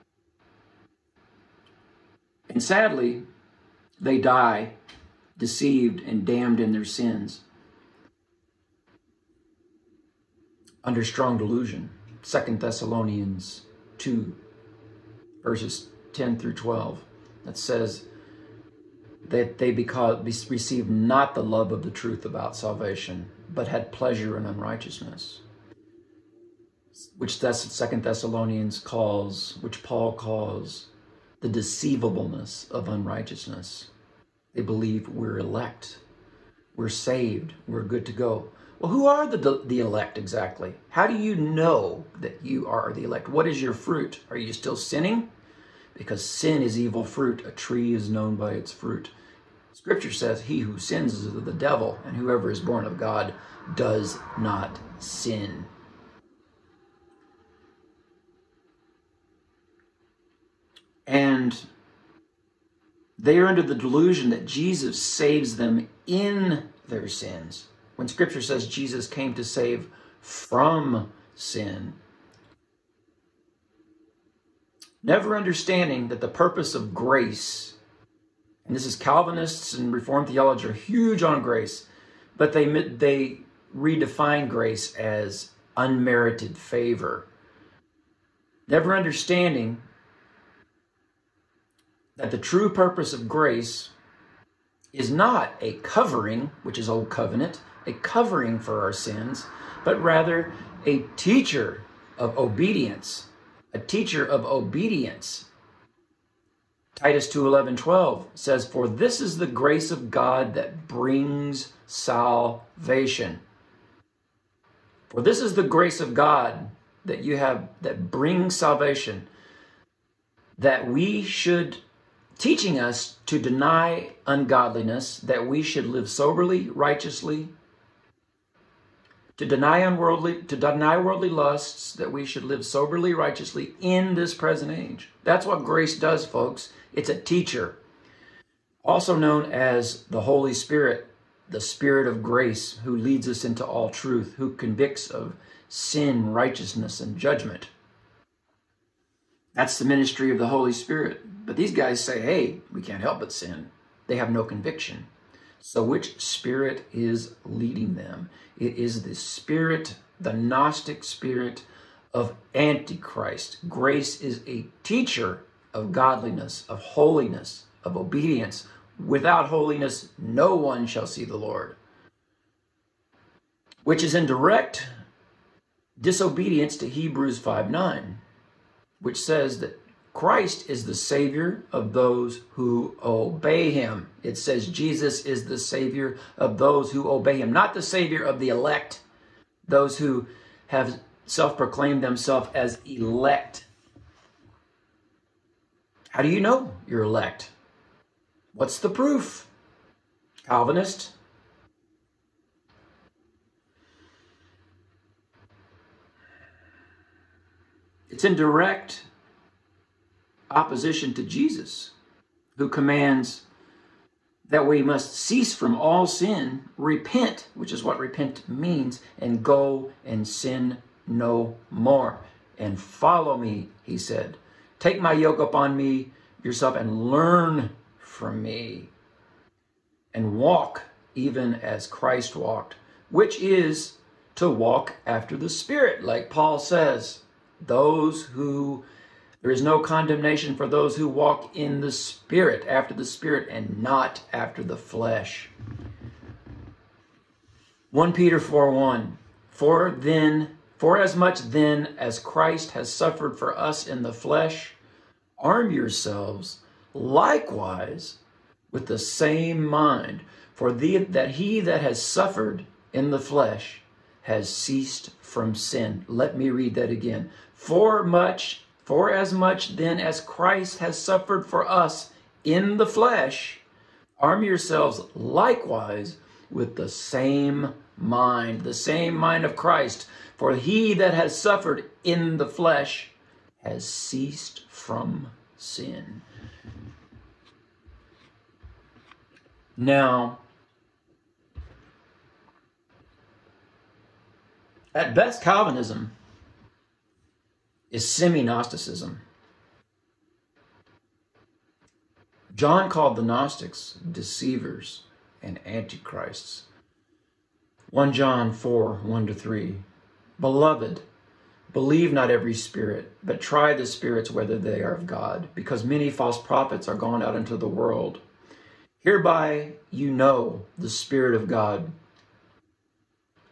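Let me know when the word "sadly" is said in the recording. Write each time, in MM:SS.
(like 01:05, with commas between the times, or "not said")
00:02.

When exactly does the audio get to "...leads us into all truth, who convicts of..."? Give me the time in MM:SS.
02:22.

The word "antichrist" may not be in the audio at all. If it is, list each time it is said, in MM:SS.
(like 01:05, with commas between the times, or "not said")
02:42, 05:05.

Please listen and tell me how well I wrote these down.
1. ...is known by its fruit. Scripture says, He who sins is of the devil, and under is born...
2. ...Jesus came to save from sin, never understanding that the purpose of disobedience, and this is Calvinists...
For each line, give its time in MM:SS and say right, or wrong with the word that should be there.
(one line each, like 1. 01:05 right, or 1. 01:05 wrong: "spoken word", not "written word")
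1. 00:47 wrong: "whoever", not "under"
2. 01:08 wrong: "grace", not "disobedience".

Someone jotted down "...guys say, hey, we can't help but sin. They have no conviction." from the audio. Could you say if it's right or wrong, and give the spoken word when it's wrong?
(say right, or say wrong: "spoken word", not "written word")
right.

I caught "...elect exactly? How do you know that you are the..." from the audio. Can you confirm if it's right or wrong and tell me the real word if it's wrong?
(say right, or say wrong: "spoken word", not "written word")
right.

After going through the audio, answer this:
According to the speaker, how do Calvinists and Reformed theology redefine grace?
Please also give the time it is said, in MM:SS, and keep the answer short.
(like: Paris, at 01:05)
Unmerited favor, at 01:25.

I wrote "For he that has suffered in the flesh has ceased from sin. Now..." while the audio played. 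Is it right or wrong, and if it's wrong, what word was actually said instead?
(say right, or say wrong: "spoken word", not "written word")
right.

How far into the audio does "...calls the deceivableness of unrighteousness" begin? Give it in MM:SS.
00:30.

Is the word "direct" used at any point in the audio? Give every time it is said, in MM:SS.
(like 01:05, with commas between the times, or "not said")
02:54, 03:28.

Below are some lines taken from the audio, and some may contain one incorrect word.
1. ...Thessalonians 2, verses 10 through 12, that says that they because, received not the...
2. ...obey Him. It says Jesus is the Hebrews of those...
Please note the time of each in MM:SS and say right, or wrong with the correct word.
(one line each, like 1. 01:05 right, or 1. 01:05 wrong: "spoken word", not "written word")
1. 00:12 right
2. 03:03 wrong: "Savior", not "Hebrews".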